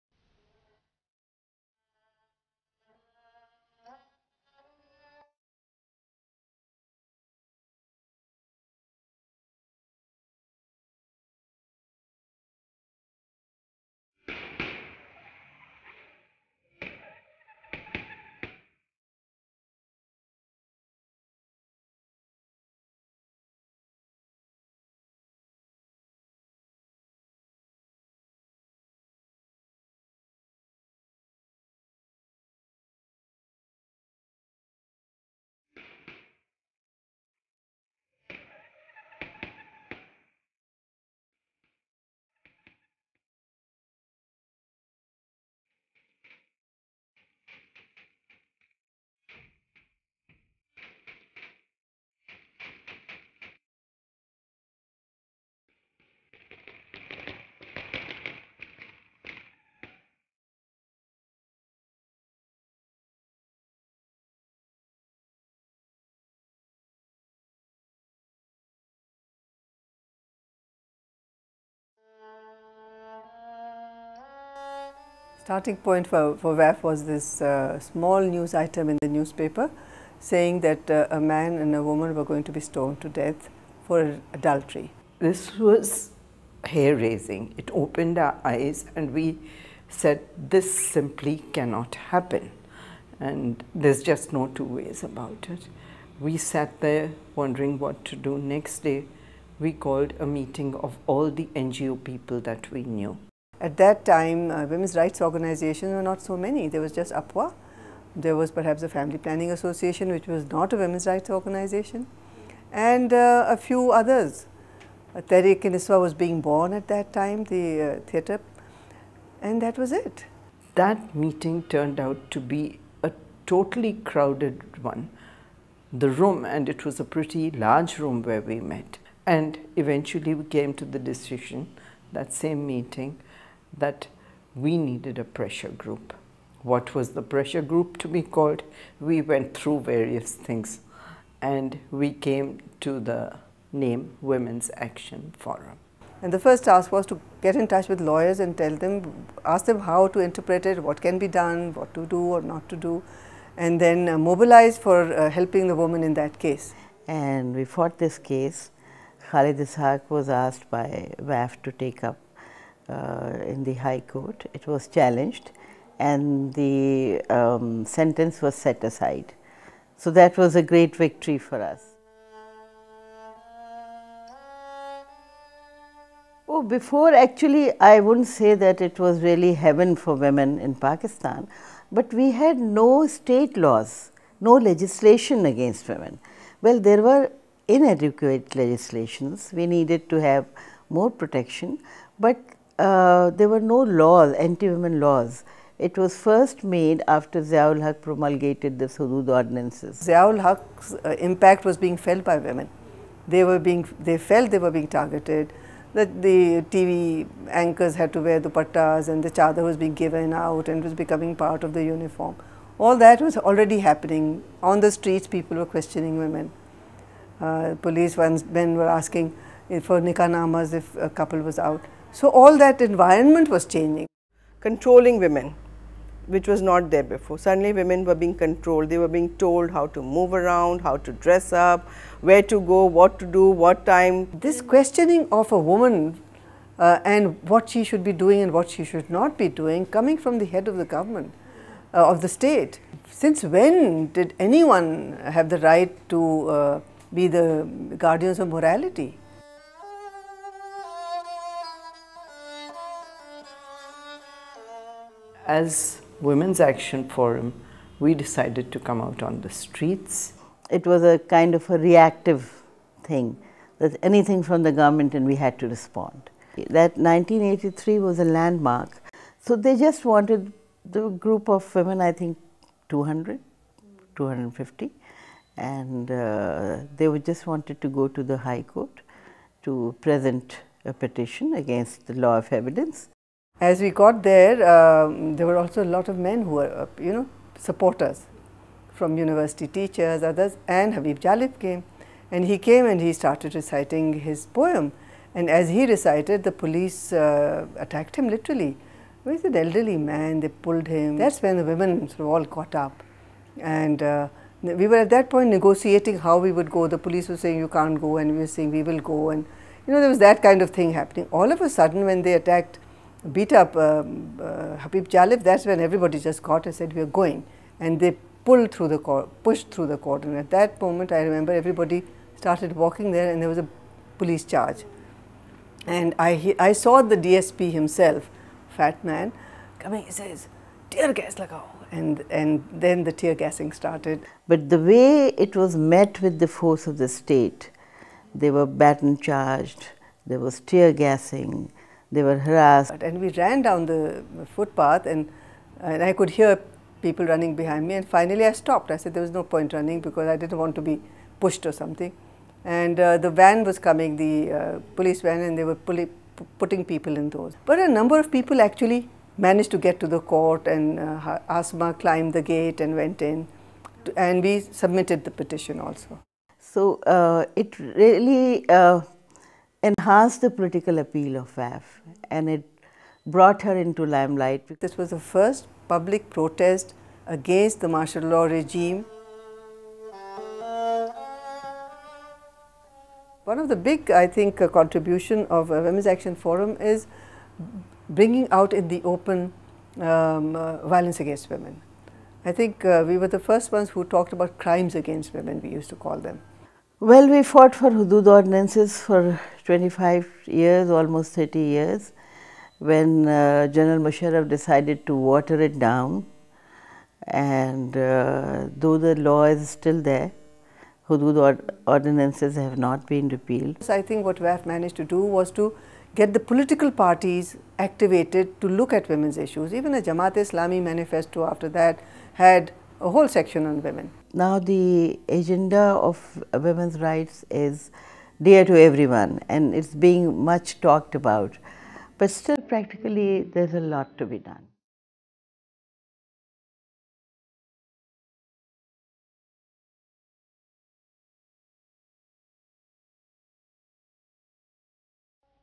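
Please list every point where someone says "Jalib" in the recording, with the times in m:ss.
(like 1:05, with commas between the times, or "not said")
4:51, 5:15.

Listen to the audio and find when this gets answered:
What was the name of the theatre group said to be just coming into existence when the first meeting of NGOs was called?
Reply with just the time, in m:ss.
1:55.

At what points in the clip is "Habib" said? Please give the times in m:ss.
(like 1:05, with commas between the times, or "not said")
4:50, 5:14.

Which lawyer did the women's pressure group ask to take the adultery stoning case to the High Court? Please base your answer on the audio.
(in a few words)
Khalid Ishaq.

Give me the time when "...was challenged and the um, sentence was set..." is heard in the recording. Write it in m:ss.
2:44.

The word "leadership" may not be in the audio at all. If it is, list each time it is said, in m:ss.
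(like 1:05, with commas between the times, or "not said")
not said.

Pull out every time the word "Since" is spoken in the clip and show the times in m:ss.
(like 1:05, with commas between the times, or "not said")
4:03.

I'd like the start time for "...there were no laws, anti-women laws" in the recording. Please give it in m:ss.
3:13.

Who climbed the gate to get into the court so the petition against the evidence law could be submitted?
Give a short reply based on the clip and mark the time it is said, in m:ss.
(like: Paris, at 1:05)
Asma, at 6:01.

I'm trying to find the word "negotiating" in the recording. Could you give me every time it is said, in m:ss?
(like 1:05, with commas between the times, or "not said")
5:05.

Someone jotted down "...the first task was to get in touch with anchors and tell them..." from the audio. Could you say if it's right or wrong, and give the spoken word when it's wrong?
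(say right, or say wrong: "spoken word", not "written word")
wrong: "lawyers", not "anchors".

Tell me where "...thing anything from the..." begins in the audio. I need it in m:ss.
4:23.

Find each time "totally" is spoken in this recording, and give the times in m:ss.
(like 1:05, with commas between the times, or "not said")
2:03.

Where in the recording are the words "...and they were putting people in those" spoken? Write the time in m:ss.
5:55.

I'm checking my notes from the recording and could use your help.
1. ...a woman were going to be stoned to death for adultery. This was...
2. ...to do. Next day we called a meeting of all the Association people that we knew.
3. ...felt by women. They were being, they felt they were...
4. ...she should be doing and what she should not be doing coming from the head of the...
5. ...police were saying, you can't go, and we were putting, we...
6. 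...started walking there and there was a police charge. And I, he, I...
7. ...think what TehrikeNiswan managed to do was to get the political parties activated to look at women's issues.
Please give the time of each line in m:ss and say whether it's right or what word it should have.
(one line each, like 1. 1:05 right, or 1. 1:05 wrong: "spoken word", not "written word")
1. 1:21 right
2. 1:38 wrong: "NGO", not "Association"
3. 3:21 right
4. 3:57 right
5. 5:06 wrong: "saying", not "putting"
6. 5:22 right
7. 6:54 wrong: "WAF", not "TehrikeNiswan".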